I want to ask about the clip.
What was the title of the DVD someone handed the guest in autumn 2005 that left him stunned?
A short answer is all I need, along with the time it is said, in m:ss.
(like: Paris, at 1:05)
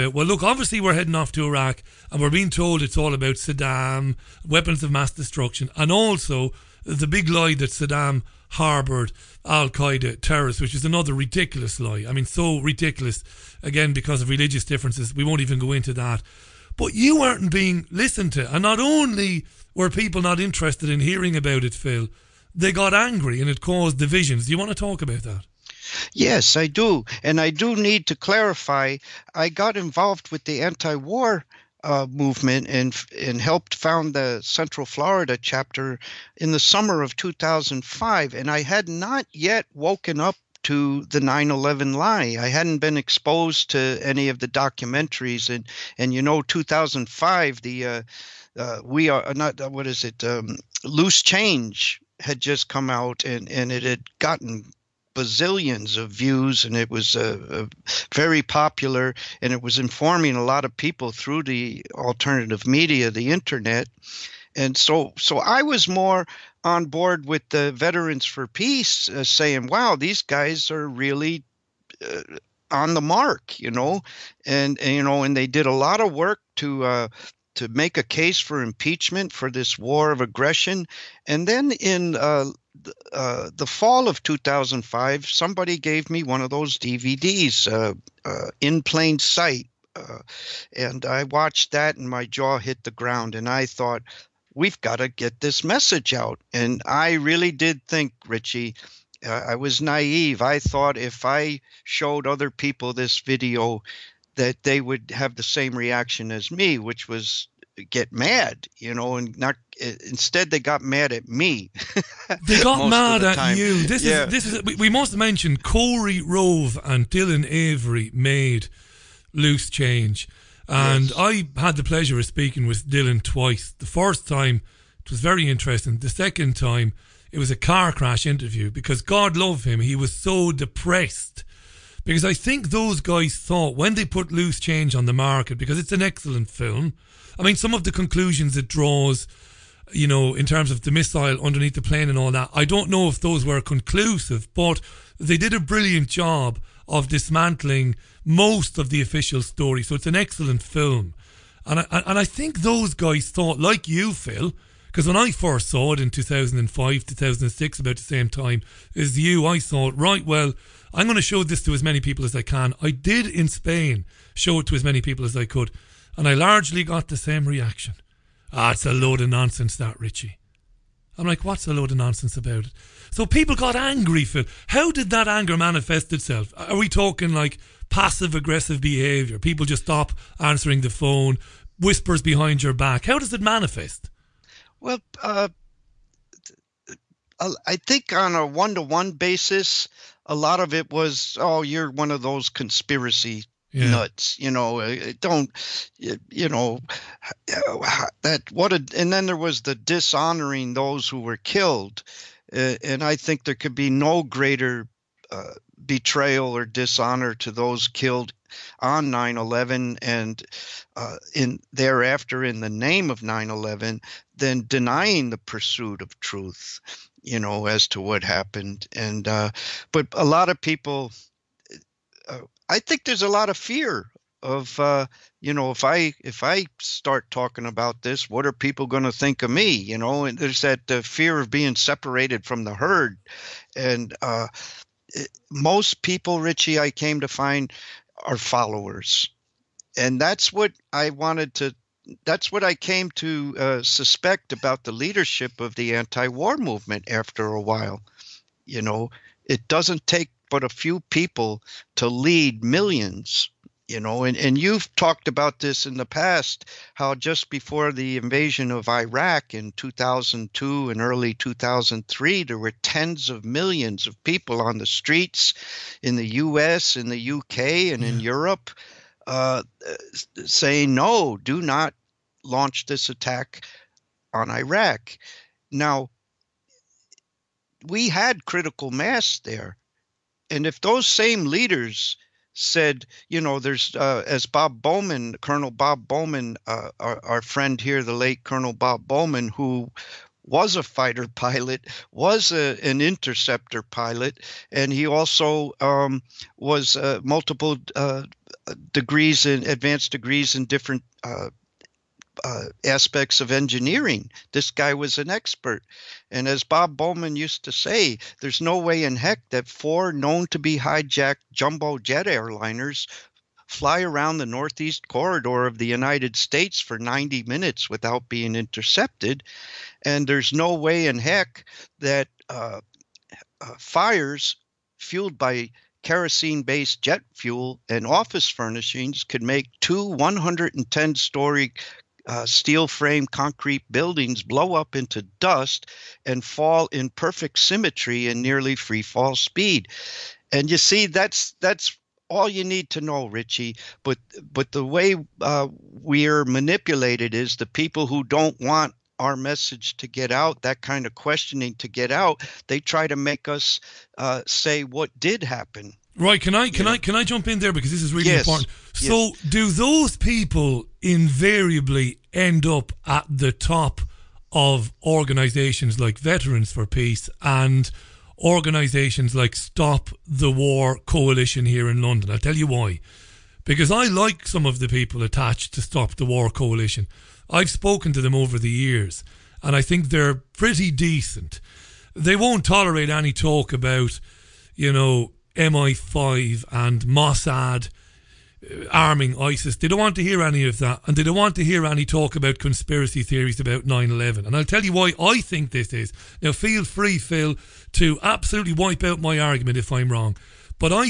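In Plain Sight, at 1:28.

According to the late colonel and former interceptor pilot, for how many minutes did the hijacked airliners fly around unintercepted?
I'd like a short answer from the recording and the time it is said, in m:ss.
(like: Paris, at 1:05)
90, at 5:16.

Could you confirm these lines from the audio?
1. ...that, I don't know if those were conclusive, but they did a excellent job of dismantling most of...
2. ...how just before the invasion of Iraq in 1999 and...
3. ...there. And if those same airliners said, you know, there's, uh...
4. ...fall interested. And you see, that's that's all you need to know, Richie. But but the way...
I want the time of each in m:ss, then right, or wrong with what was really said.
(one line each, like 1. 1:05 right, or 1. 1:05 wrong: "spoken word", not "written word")
1. 2:22 wrong: "brilliant", not "excellent"
2. 4:16 wrong: "2002", not "1999"
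3. 4:39 wrong: "leaders", not "airliners"
4. 5:39 wrong: "speed", not "interested".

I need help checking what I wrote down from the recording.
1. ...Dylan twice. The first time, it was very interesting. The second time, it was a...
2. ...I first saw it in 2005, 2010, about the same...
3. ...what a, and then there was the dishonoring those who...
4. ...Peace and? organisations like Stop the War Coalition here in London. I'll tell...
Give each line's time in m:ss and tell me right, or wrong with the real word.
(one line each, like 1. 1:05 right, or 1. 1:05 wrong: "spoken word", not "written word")
1. 2:02 right
2. 2:35 wrong: "2006", not "2010"
3. 3:18 right
4. 6:06 right.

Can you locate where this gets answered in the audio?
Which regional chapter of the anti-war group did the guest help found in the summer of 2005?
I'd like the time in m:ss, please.
0:34.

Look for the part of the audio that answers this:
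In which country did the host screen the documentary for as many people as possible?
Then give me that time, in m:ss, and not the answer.
2:43.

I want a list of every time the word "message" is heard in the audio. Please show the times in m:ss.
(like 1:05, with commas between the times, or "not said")
1:35, 5:49.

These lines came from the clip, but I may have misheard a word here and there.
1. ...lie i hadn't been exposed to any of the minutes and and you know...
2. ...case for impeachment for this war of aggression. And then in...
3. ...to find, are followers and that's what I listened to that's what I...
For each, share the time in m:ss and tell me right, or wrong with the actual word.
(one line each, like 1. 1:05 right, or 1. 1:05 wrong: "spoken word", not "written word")
1. 0:41 wrong: "documentaries", not "minutes"
2. 1:18 right
3. 3:57 wrong: "wanted", not "listened".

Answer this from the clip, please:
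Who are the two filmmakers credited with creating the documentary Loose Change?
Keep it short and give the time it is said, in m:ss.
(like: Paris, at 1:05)
Korey Rowe and Dylan Avery, at 1:55.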